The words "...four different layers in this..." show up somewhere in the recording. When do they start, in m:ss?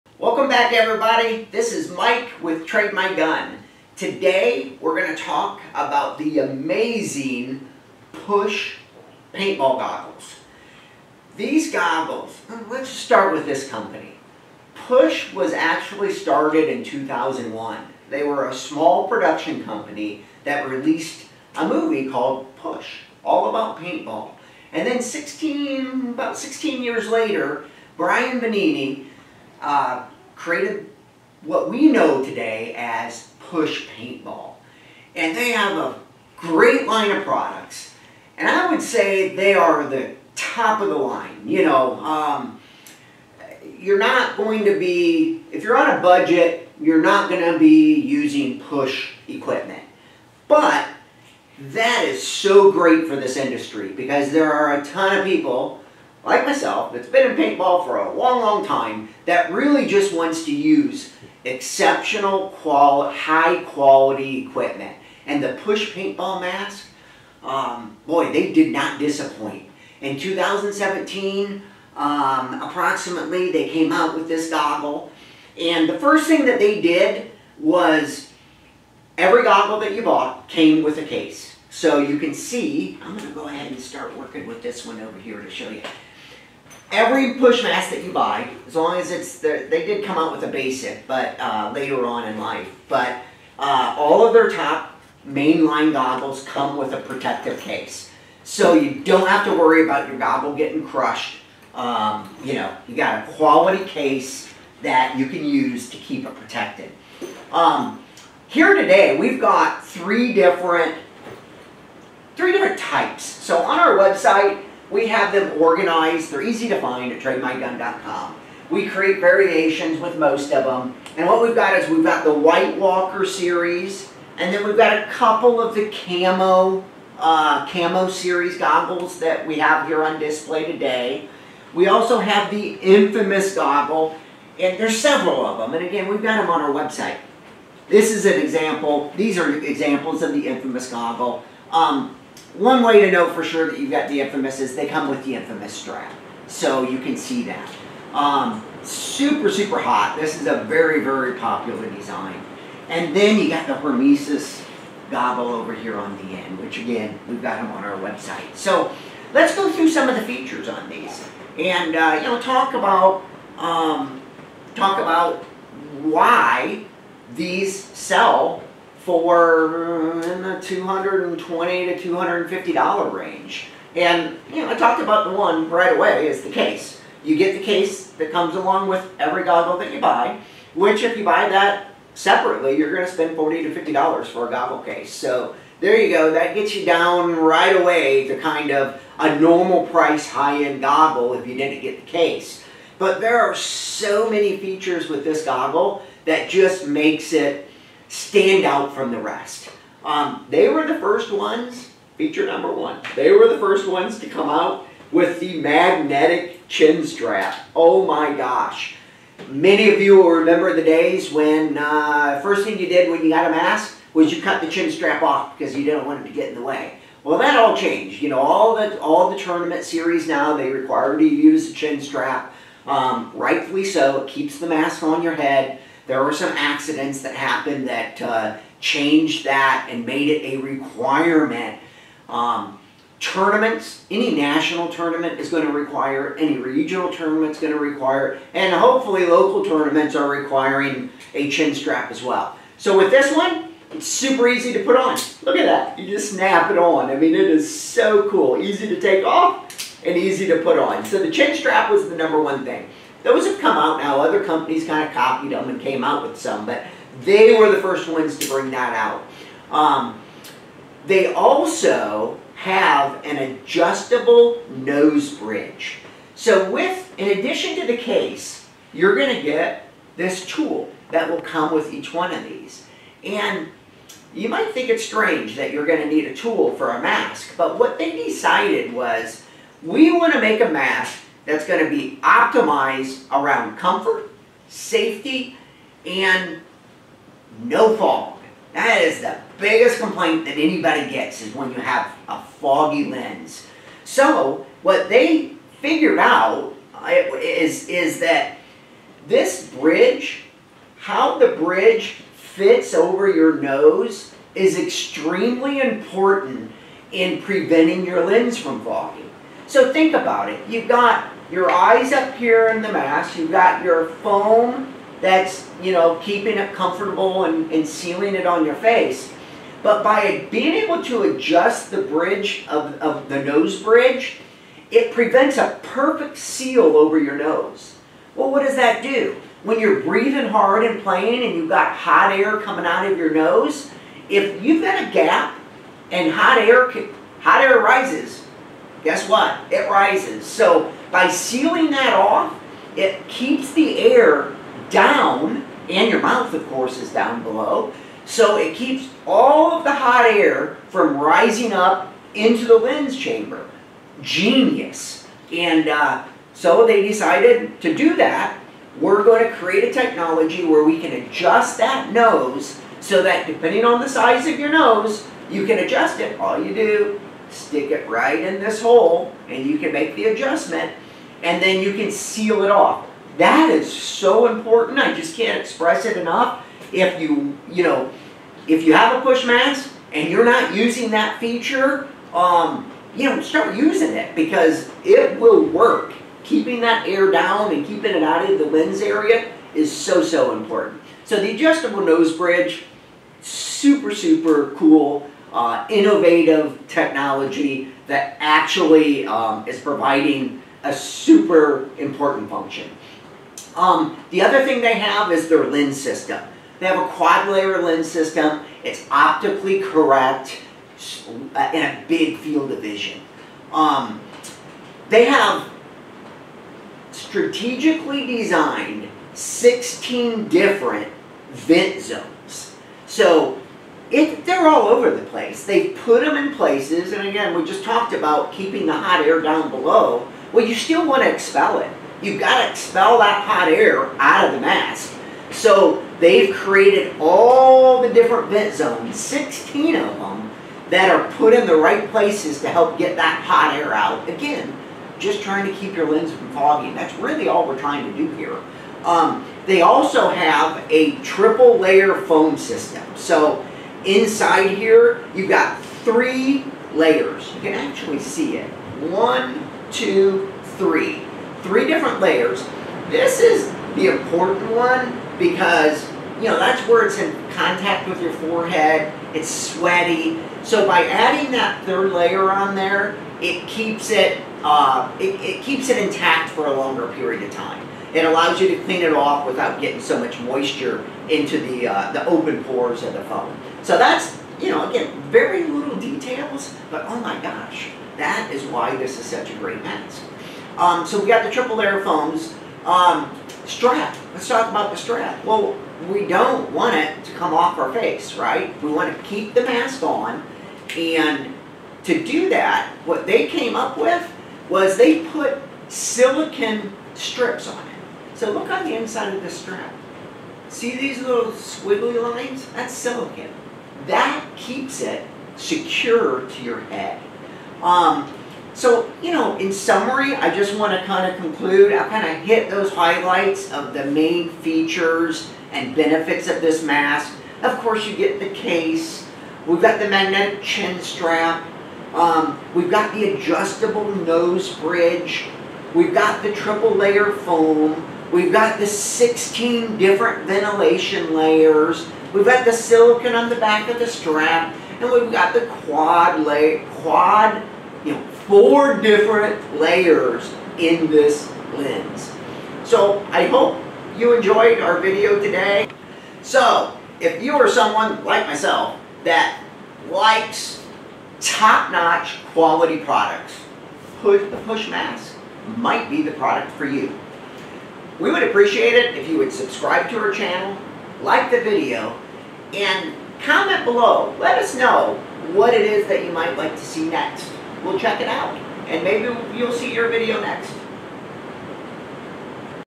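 9:08.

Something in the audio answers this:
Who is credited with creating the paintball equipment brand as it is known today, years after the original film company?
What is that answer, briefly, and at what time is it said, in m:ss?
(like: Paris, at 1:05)
Brian Benini, at 0:27.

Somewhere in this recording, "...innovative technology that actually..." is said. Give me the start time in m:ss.
6:35.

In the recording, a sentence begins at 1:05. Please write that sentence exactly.
And the push paintball mask, um, boy, they did not disappoint.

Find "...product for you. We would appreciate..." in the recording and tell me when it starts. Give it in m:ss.
9:26.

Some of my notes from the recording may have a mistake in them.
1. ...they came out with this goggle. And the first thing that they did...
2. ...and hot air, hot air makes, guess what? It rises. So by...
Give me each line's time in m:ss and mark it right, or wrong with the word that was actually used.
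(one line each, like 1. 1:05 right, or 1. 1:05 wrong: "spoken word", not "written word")
1. 1:13 right
2. 5:36 wrong: "rises", not "makes".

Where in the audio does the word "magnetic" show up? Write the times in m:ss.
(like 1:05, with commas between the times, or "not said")
3:25, 8:50.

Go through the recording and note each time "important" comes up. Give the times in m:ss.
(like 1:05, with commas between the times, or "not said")
5:05, 6:14, 6:30, 6:41, 7:44.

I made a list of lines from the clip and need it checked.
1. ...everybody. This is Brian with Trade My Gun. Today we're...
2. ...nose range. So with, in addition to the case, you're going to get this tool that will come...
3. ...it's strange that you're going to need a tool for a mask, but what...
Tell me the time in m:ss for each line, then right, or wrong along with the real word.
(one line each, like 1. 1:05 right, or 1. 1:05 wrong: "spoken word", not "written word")
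1. 0:00 wrong: "Mike", not "Brian"
2. 4:24 wrong: "bridge", not "range"
3. 4:34 right.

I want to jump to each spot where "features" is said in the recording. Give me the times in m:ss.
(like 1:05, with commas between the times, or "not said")
2:40, 3:14, 3:22, 6:21, 8:44.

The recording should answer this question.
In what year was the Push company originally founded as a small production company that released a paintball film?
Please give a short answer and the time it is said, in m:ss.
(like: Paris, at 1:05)
2001, at 0:16.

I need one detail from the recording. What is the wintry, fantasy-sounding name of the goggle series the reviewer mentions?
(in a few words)
White Walker.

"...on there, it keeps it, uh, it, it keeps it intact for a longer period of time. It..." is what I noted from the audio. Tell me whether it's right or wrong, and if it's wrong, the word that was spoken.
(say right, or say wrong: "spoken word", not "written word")
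right.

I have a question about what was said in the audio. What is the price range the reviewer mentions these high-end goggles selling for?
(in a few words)
$220 to $250.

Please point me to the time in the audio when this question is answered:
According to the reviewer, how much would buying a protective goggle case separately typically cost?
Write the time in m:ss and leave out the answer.
3:03.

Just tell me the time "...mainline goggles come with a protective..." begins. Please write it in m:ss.
1:35.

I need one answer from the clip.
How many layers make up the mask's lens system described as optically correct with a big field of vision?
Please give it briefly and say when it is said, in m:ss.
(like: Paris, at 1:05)
4 (quad-layer), at 6:47.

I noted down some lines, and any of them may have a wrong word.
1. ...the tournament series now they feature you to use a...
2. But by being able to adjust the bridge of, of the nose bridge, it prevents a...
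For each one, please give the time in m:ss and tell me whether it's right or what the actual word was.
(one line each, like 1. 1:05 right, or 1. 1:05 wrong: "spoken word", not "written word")
1. 3:39 wrong: "require", not "feature"
2. 5:19 right.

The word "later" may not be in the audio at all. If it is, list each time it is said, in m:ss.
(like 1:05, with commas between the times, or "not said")
0:27, 1:31.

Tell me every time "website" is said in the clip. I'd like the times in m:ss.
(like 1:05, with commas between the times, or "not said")
1:53, 2:16, 2:37.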